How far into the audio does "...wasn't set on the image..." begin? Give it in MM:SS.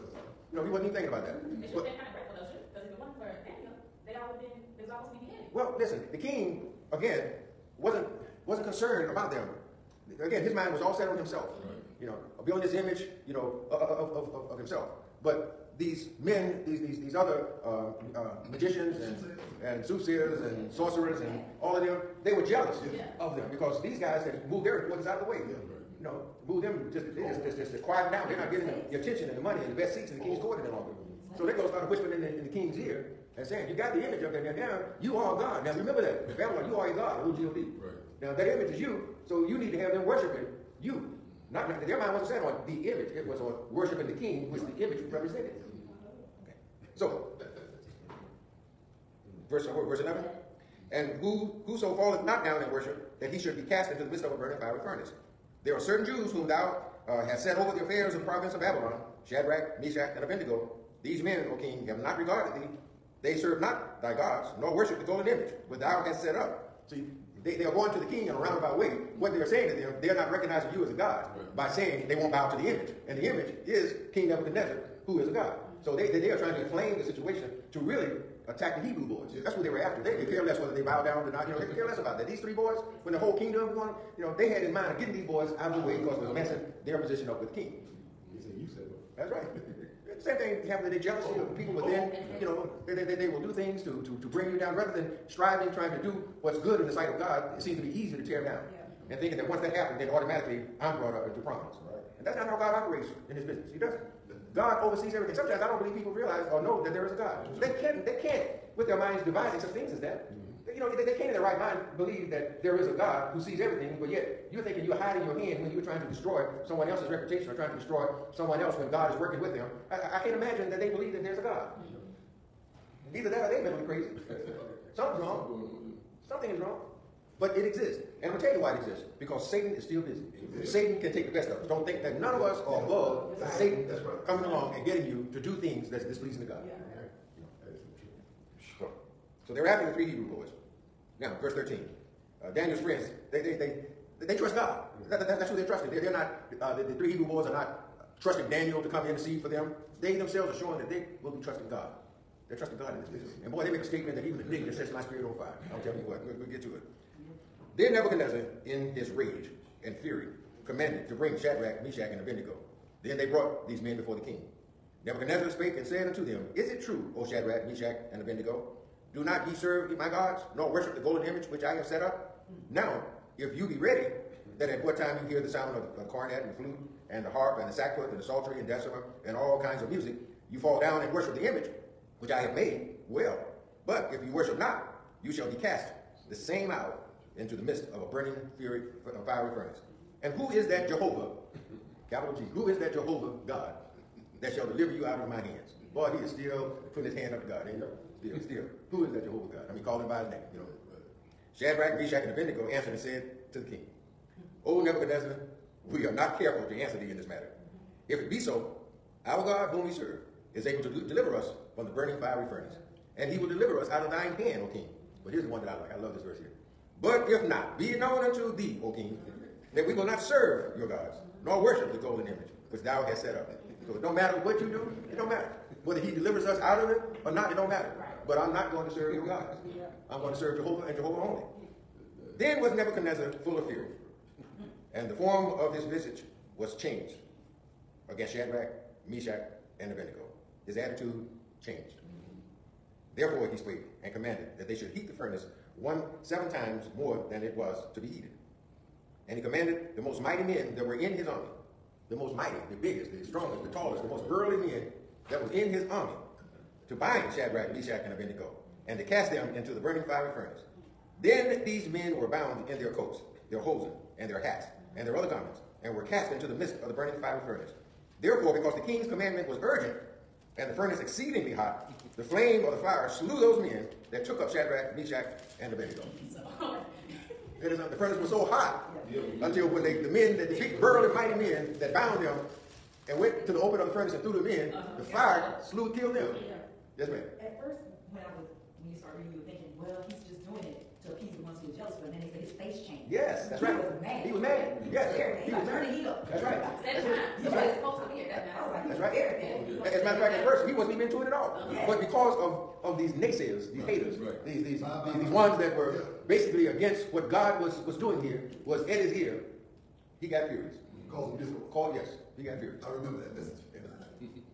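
00:42.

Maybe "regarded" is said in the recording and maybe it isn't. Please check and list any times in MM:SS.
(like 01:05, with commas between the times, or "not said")
01:02.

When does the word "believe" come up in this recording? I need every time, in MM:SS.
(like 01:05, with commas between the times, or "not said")
01:45, 01:51, 02:00.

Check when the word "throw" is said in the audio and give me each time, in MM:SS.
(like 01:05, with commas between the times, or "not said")
not said.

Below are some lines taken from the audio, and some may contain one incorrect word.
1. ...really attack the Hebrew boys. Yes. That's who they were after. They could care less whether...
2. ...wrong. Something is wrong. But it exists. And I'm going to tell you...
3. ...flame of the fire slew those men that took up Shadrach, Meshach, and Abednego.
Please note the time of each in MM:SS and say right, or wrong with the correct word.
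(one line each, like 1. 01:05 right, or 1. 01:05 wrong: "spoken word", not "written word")
1. 01:17 right
2. 02:05 right
3. 04:32 right.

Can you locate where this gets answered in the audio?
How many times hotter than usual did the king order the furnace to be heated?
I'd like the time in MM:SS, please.
04:06.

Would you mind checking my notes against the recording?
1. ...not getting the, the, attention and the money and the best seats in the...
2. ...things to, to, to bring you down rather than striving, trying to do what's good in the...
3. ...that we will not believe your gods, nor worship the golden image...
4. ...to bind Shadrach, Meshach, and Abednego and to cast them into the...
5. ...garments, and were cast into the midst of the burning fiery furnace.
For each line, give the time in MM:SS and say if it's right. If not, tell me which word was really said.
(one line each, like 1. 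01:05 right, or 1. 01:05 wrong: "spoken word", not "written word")
1. 00:28 right
2. 01:33 right
3. 03:39 wrong: "serve", not "believe"
4. 04:16 right
5. 04:25 right.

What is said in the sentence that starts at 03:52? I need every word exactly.
Then was Nebuchadnezzar full of fury and the form of his visage was changed against Shadrach, Meshach, and Abednego.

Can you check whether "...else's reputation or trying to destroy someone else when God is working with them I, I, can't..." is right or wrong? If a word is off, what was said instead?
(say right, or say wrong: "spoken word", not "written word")
right.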